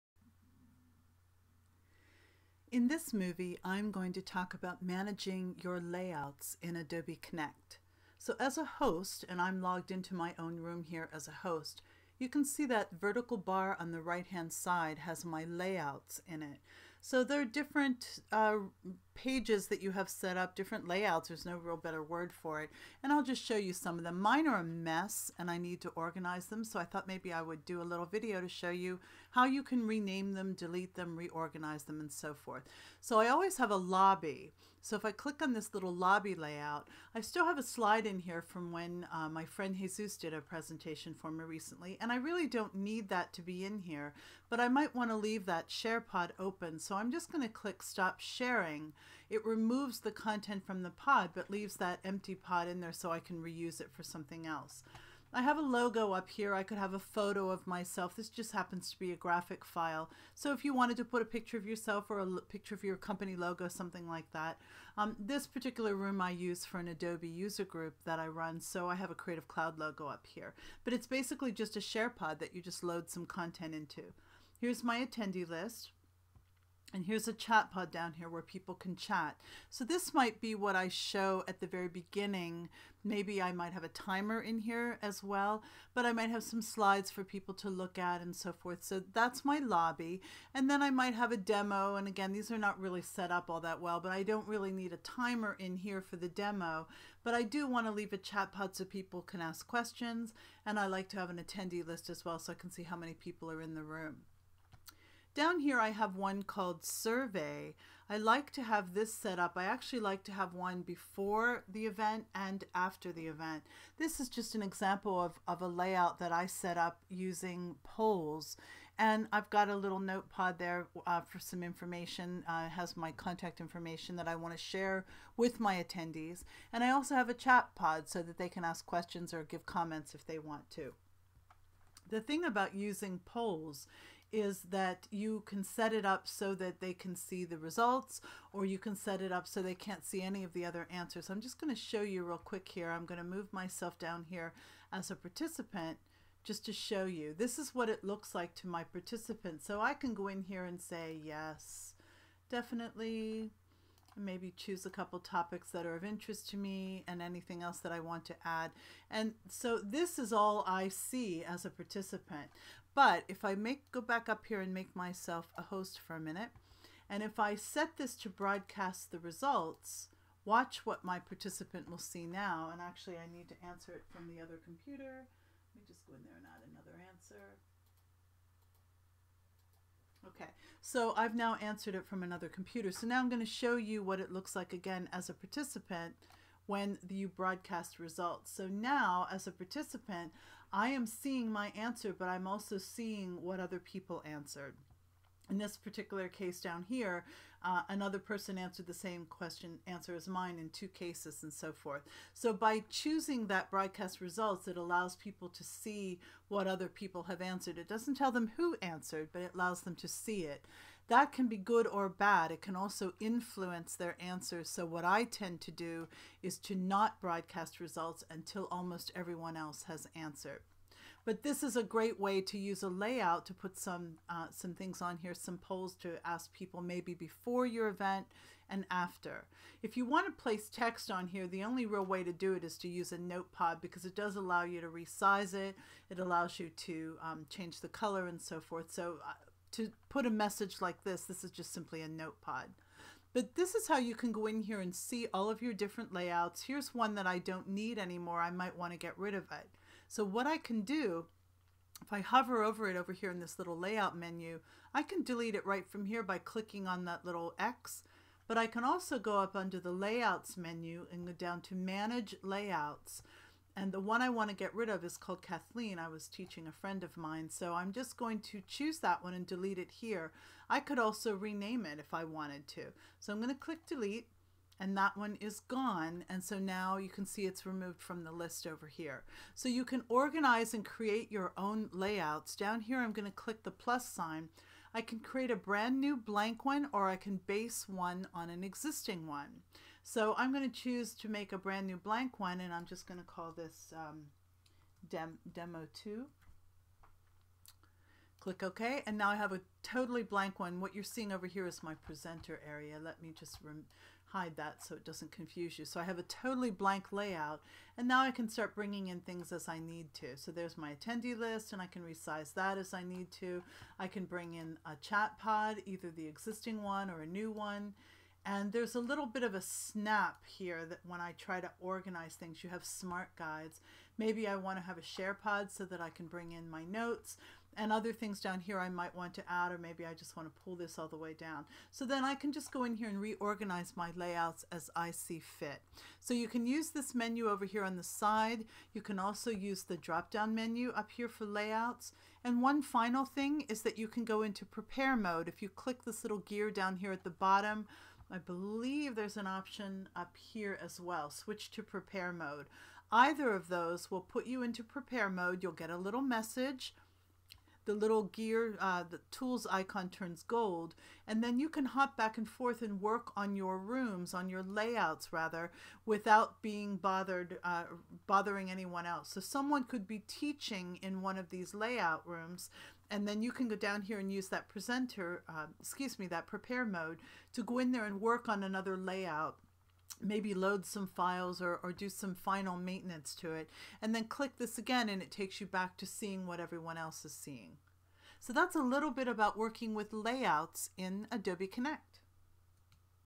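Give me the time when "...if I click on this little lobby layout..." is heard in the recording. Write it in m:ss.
0:34.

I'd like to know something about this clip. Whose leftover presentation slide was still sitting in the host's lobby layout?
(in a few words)
Jesus.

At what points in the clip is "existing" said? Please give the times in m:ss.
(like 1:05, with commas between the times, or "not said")
4:48, 5:16.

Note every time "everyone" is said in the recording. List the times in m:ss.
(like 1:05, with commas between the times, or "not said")
3:39, 6:26.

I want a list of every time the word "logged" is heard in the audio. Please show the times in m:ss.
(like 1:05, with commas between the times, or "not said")
0:09.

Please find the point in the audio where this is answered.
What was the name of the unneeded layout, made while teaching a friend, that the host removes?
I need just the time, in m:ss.
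4:25.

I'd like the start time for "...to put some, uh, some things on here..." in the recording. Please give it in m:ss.
3:43.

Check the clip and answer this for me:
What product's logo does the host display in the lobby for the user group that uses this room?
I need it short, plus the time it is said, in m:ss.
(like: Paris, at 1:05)
Creative Cloud, at 1:09.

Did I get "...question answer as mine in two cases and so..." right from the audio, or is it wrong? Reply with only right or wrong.
right.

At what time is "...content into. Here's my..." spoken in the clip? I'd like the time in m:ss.
1:13.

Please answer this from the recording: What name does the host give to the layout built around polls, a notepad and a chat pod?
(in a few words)
survey.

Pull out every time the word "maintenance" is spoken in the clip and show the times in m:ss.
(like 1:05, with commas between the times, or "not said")
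6:22.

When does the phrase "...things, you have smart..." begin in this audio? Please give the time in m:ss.
5:22.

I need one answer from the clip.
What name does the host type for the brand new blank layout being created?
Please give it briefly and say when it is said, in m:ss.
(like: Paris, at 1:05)
Demo 2, at 4:55.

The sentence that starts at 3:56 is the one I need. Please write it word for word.
It allows you to um, change the color and so forth.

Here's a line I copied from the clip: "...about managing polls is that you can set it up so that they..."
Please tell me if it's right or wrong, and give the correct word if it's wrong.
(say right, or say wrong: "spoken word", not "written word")
wrong: "using", not "managing".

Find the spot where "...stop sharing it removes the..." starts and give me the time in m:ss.
0:47.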